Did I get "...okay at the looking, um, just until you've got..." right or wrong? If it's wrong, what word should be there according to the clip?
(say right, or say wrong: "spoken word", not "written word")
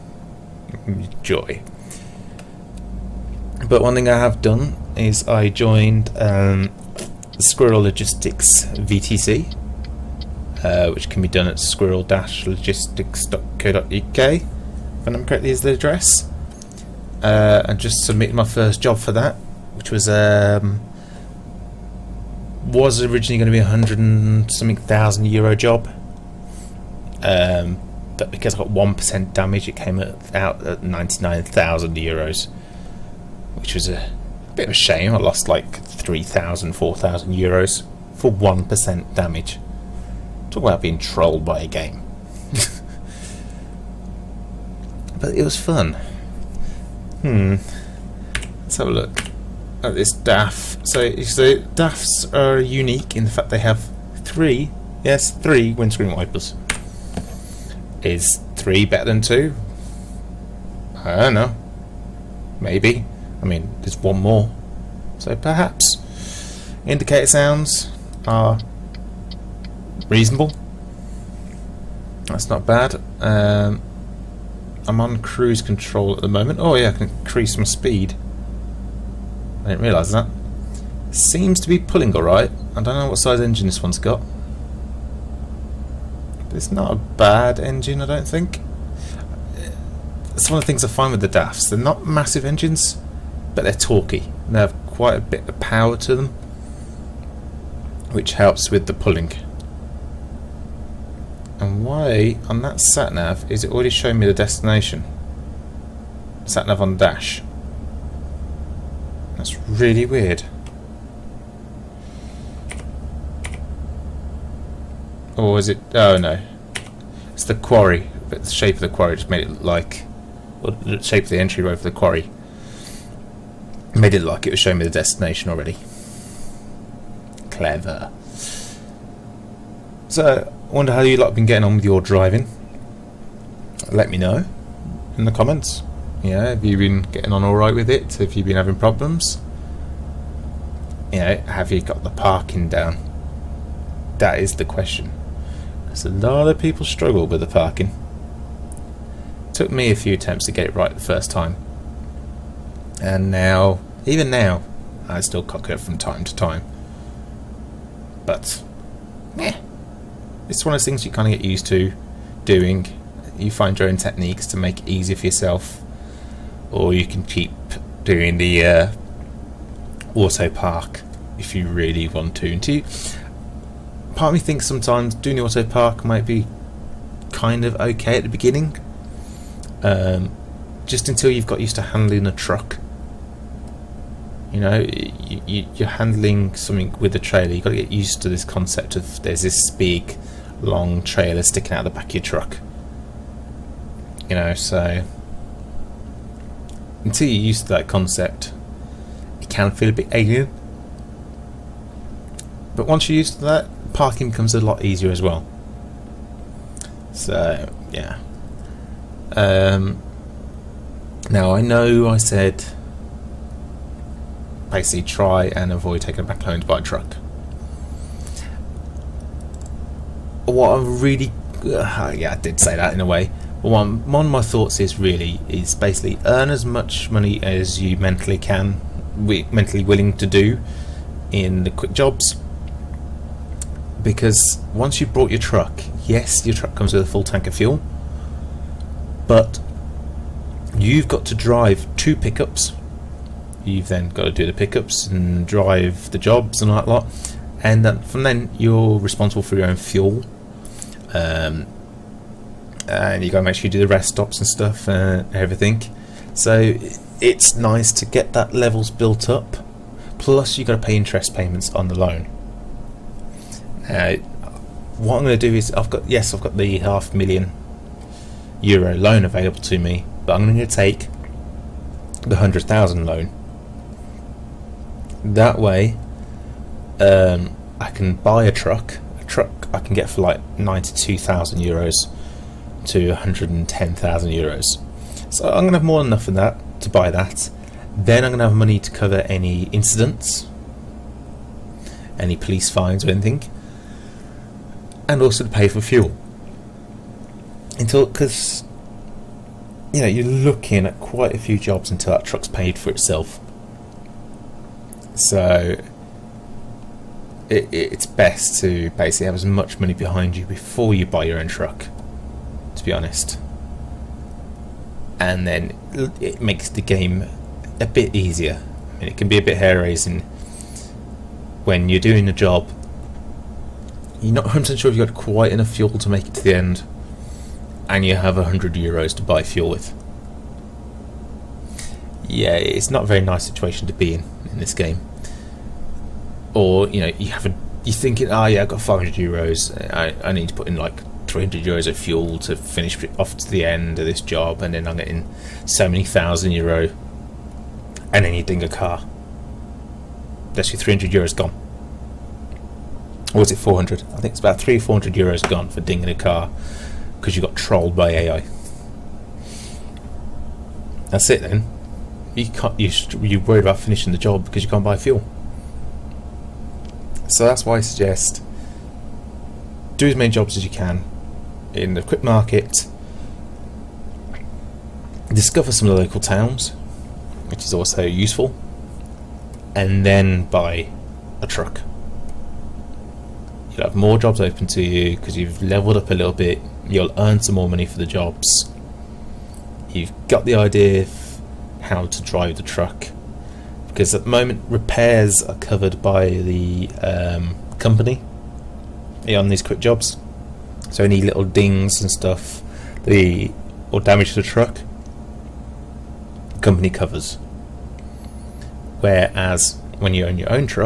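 wrong: "beginning", not "looking".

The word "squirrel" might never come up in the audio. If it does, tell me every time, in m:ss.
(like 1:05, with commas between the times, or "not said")
0:07, 0:11.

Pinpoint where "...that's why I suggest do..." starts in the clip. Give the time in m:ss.
6:07.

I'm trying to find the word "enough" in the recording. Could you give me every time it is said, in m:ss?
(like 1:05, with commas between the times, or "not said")
4:46, 5:25.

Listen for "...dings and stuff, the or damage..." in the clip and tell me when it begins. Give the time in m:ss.
6:41.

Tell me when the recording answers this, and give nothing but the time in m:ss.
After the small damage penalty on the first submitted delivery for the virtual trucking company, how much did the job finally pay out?
0:30.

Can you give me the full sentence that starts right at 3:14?
You know, so until you're used to that concept, it can feel a bit alien.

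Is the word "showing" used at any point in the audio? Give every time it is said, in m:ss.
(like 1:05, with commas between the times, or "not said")
1:43, 2:04.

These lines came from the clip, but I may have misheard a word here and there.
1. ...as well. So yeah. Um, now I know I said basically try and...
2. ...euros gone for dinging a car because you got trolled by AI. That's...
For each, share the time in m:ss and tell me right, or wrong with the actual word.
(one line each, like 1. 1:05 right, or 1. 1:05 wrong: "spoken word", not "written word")
1. 3:25 right
2. 5:55 right.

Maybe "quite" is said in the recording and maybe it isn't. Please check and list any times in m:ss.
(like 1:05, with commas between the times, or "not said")
1:34, 5:00, 5:25.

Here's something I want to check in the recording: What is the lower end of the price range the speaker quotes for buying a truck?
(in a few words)
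92,000 euros.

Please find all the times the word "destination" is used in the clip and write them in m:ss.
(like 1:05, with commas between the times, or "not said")
1:44, 2:04.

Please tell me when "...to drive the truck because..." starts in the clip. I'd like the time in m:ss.
6:32.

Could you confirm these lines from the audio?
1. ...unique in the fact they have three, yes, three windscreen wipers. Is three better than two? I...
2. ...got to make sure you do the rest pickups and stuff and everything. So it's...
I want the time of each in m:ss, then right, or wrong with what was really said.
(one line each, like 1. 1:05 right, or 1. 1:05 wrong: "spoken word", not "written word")
1. 0:52 right
2. 4:13 wrong: "stops", not "pickups".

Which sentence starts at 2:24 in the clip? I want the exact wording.
That is the question as a lot of people struggle with the parking.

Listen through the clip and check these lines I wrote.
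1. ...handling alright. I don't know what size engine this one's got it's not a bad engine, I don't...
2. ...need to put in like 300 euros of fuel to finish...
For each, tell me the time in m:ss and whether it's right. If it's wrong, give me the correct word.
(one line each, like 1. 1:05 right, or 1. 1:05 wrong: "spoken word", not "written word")
1. 1:21 wrong: "pulling", not "handling"
2. 5:40 right.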